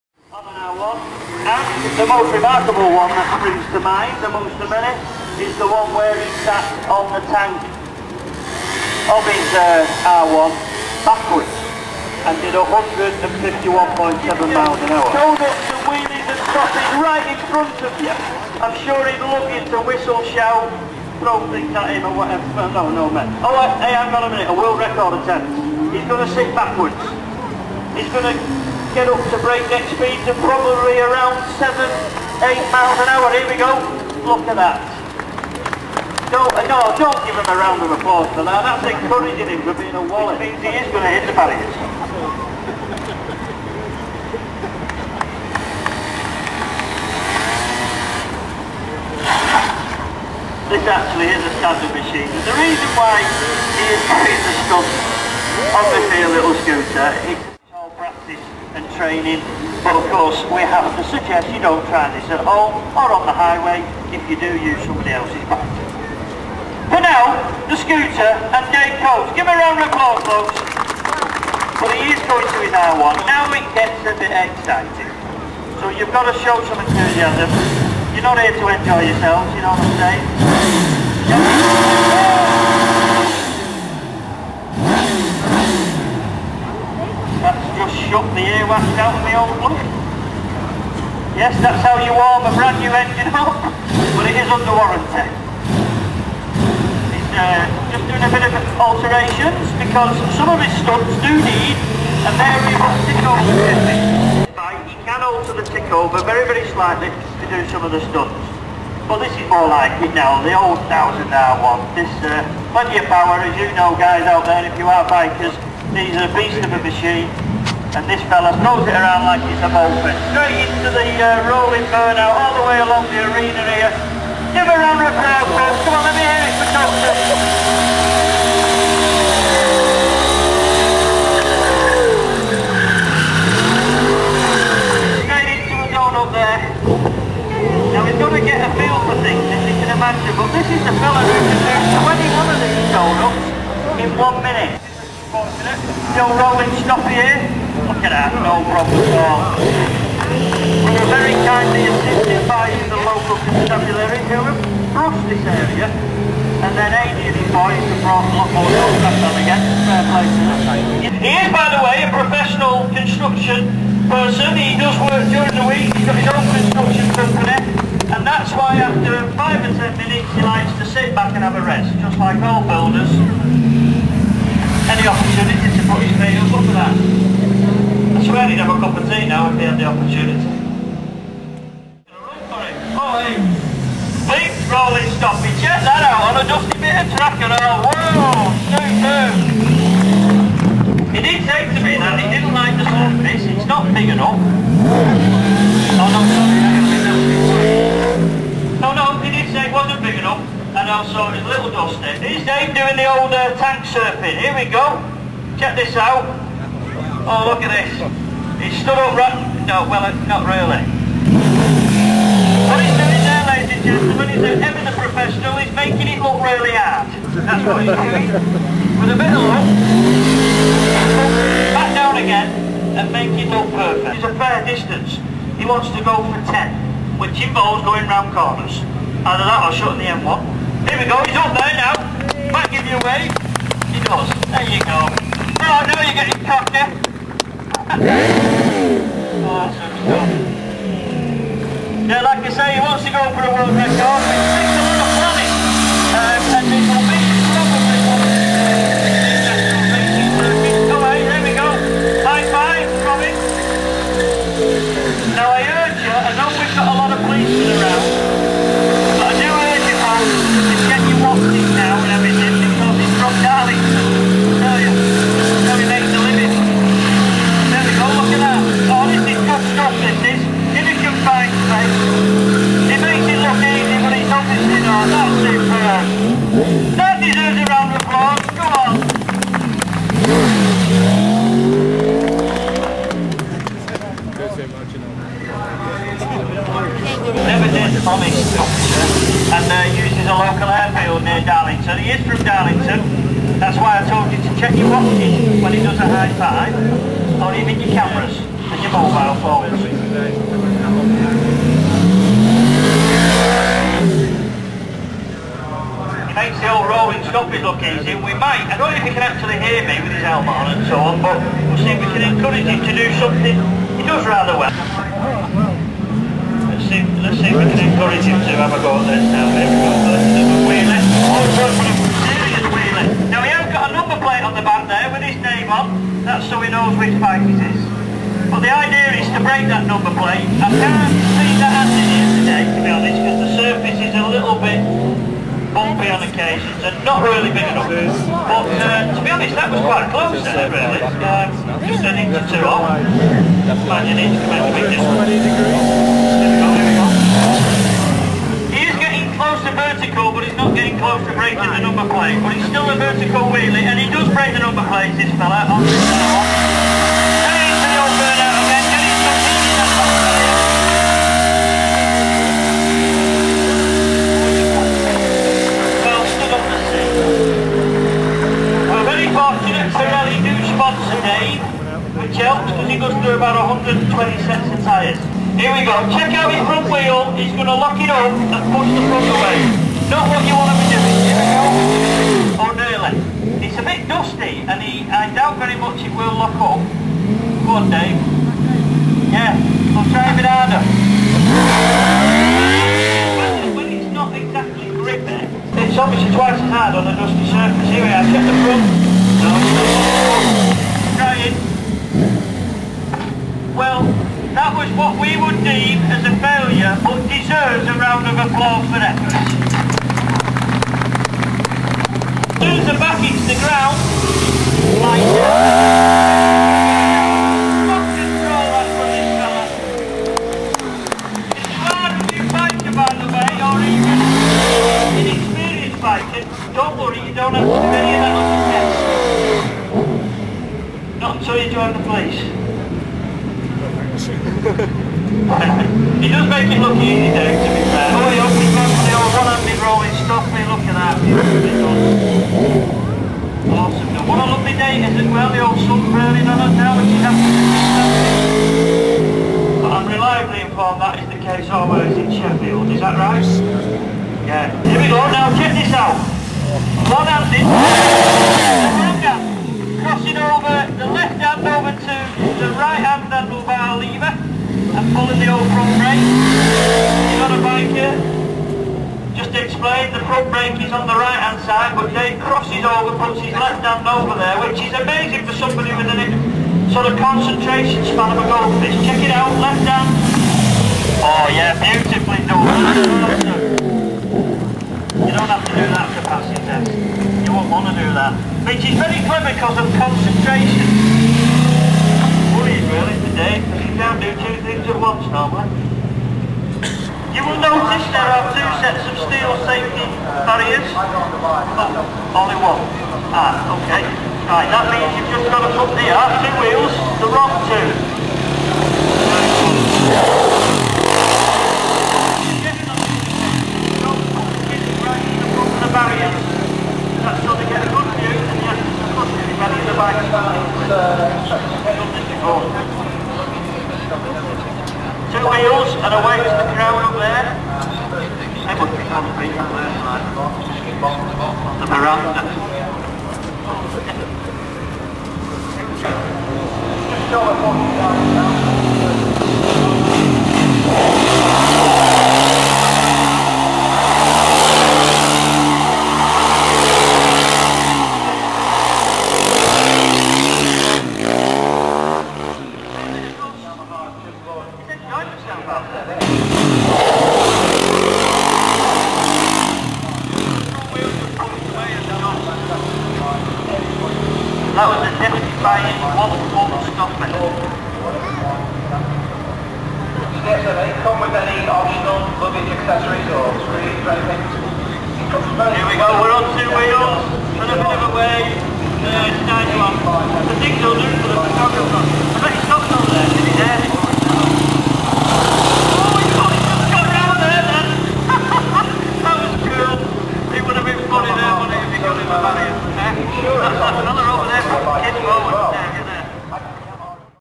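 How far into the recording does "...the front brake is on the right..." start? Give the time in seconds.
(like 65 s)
470 s.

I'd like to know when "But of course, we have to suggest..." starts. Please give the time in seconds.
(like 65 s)
59 s.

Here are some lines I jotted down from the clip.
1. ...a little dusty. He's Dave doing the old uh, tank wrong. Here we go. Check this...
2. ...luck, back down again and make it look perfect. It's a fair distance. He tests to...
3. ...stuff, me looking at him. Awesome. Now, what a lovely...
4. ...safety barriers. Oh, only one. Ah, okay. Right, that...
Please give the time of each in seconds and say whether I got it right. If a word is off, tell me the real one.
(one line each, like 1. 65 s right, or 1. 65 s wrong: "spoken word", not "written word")
1. 201 s wrong: "surfing", not "wrong"
2. 219 s wrong: "wants", not "tests"
3. 440 s right
4. 499 s right.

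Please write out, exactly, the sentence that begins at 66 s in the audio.
For now, the scooter and Dave Coates.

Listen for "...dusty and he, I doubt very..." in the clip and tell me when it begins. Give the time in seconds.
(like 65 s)
384 s.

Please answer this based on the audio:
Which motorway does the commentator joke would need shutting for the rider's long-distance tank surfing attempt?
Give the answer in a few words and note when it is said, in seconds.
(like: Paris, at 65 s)
M1, at 230 s.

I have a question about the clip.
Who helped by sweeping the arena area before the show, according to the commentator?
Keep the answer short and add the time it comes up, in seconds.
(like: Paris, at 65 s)
local constabulary, at 153 s.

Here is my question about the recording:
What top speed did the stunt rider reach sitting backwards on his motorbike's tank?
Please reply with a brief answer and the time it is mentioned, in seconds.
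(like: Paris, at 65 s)
151.7 miles an hour, at 12 s.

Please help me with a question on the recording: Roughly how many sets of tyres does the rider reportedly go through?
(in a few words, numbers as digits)
120.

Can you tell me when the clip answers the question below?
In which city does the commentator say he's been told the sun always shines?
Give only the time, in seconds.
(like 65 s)
452 s.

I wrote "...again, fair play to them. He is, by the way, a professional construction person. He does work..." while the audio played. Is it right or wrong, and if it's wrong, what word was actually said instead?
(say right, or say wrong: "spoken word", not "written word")
right.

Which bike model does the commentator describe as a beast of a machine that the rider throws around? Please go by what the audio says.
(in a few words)
1000R1.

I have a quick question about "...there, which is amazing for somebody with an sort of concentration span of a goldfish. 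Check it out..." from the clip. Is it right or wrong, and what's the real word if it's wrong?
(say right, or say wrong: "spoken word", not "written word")
right.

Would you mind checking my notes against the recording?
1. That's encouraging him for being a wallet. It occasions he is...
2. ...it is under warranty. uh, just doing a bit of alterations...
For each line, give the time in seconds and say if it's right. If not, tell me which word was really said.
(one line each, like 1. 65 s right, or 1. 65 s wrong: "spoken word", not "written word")
1. 38 s wrong: "means", not "occasions"
2. 94 s right.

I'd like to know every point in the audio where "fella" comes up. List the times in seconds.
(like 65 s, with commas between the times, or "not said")
118 s, 355 s.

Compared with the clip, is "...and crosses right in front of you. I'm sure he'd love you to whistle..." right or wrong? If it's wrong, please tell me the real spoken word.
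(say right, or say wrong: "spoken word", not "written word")
right.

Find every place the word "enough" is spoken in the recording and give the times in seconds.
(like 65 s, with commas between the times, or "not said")
194 s, 200 s, 337 s.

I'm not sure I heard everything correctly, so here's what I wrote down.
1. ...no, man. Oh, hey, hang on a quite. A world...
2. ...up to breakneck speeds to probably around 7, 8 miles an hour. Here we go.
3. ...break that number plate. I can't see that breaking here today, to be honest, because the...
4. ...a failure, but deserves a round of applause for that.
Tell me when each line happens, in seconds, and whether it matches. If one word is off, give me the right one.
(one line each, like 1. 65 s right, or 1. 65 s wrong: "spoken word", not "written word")
1. 22 s wrong: "minute", not "quite"
2. 29 s right
3. 329 s wrong: "happening", not "breaking"
4. 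406 s right.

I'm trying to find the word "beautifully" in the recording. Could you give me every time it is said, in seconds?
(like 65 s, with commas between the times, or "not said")
481 s.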